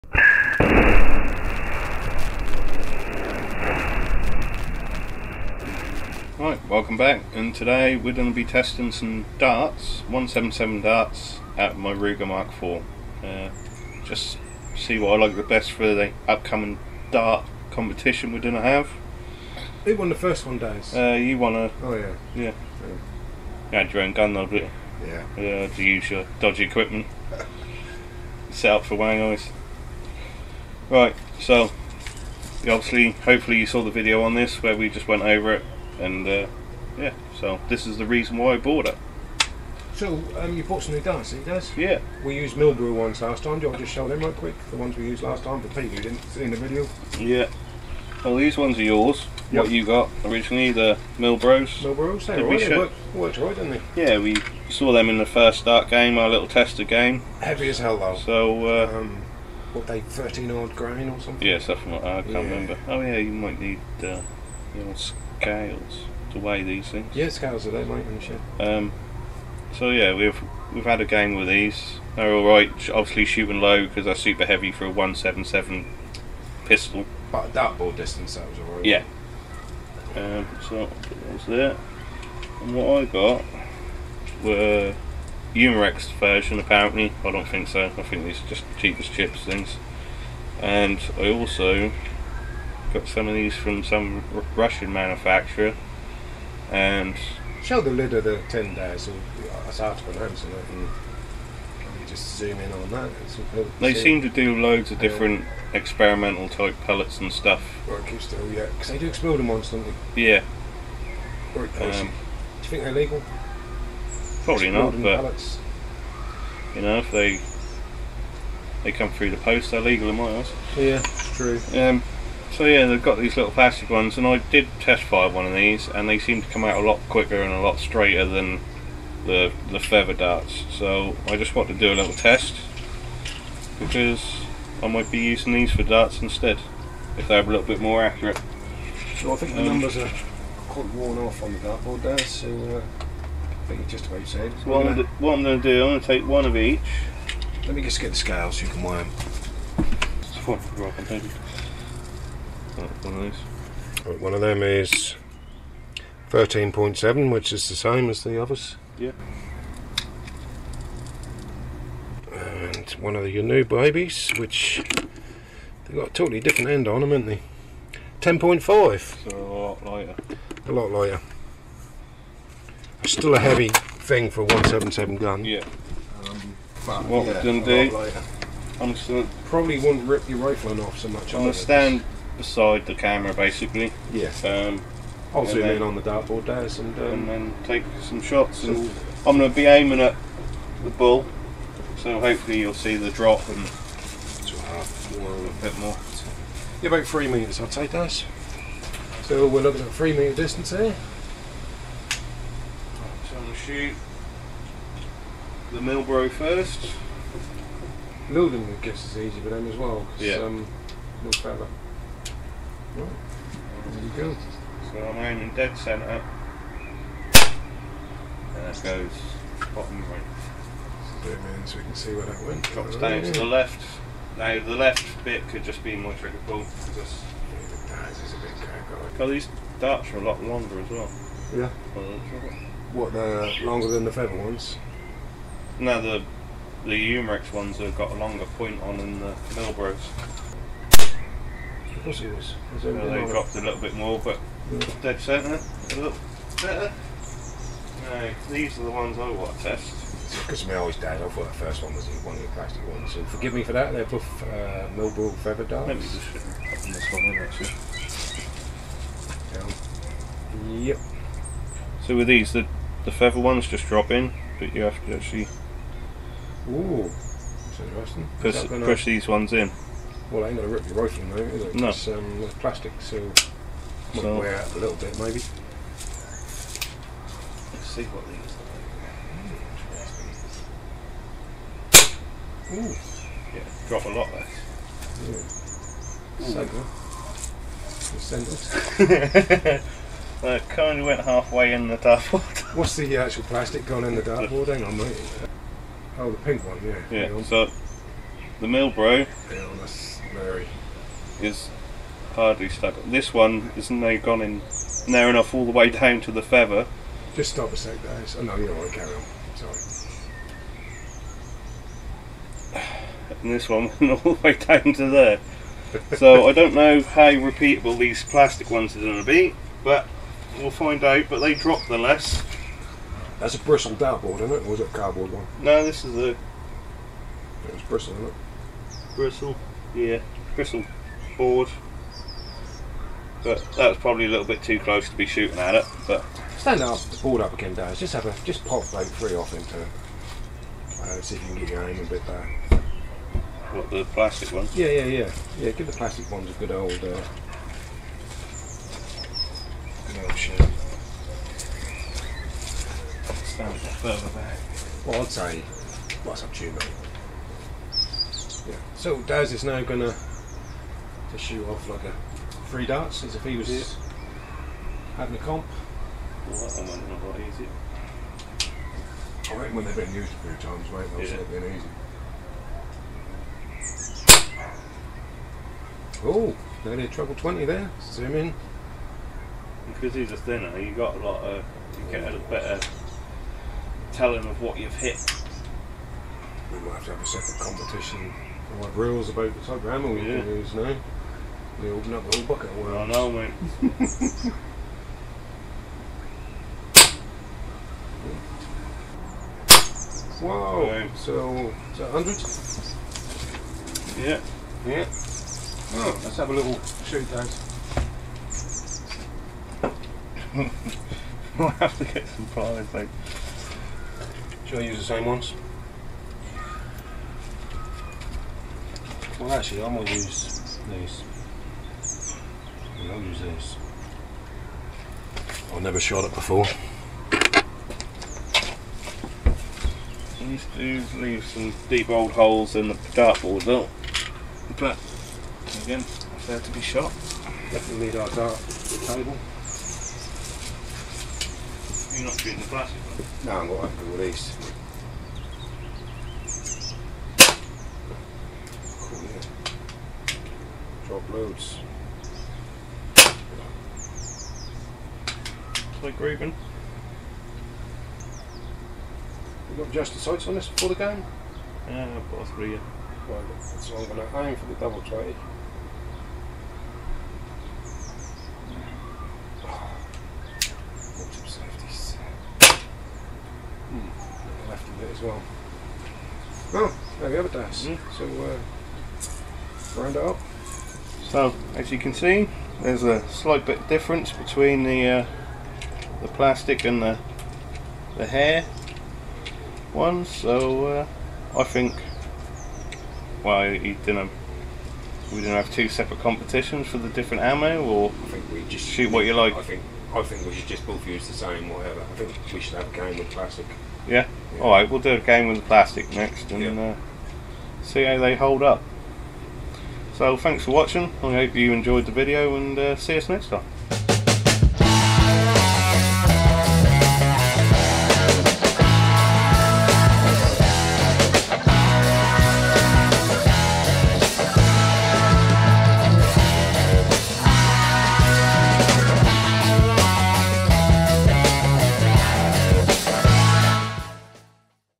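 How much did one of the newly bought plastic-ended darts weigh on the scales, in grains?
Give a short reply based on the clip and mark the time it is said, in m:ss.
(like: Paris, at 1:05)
10.5, at 2:48.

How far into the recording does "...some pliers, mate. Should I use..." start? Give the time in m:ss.
6:52.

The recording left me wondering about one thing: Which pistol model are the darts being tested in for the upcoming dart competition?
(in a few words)
Ruger Mark IV.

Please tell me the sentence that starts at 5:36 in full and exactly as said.
But stand up, board up again, Daz.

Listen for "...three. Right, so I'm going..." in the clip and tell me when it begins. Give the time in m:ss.
7:42.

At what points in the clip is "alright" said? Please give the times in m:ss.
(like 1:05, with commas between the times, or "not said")
1:18, 8:24.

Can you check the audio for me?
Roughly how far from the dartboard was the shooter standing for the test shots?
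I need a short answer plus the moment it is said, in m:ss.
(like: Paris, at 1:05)
3 metres, at 3:17.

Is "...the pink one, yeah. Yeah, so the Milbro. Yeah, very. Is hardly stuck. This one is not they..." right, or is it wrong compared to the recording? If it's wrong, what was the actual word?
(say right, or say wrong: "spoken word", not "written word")
right.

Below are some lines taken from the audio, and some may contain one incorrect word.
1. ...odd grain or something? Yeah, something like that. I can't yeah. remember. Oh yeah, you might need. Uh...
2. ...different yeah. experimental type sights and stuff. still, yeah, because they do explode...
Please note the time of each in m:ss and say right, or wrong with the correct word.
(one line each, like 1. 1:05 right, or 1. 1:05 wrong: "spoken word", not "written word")
1. 1:00 right
2. 1:44 wrong: "pellets", not "sights".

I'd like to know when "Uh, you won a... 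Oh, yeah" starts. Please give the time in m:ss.
0:20.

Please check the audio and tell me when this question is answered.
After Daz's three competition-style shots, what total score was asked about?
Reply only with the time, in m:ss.
6:42.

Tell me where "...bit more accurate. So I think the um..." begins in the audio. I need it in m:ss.
2:17.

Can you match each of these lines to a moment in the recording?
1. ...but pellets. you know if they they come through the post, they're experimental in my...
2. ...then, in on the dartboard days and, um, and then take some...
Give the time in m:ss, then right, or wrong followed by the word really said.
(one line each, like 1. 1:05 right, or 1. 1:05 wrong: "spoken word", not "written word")
1. 1:55 wrong: "legal", not "experimental"
2. 3:05 right.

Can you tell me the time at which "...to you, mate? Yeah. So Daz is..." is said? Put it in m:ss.
5:56.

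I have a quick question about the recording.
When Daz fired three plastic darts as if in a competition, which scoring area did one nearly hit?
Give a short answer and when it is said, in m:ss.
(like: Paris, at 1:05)
Treble 20, at 6:17.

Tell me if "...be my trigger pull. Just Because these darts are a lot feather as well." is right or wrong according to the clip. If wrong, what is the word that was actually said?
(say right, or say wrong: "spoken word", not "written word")
wrong: "longer", not "feather".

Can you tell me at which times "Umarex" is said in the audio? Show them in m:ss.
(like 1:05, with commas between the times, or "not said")
1:25, 3:57.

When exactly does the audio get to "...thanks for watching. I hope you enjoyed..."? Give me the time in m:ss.
8:30.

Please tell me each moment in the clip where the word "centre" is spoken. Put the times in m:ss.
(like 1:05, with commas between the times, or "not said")
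3:35, 4:05.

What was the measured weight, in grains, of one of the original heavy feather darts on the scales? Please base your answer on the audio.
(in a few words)
13.7.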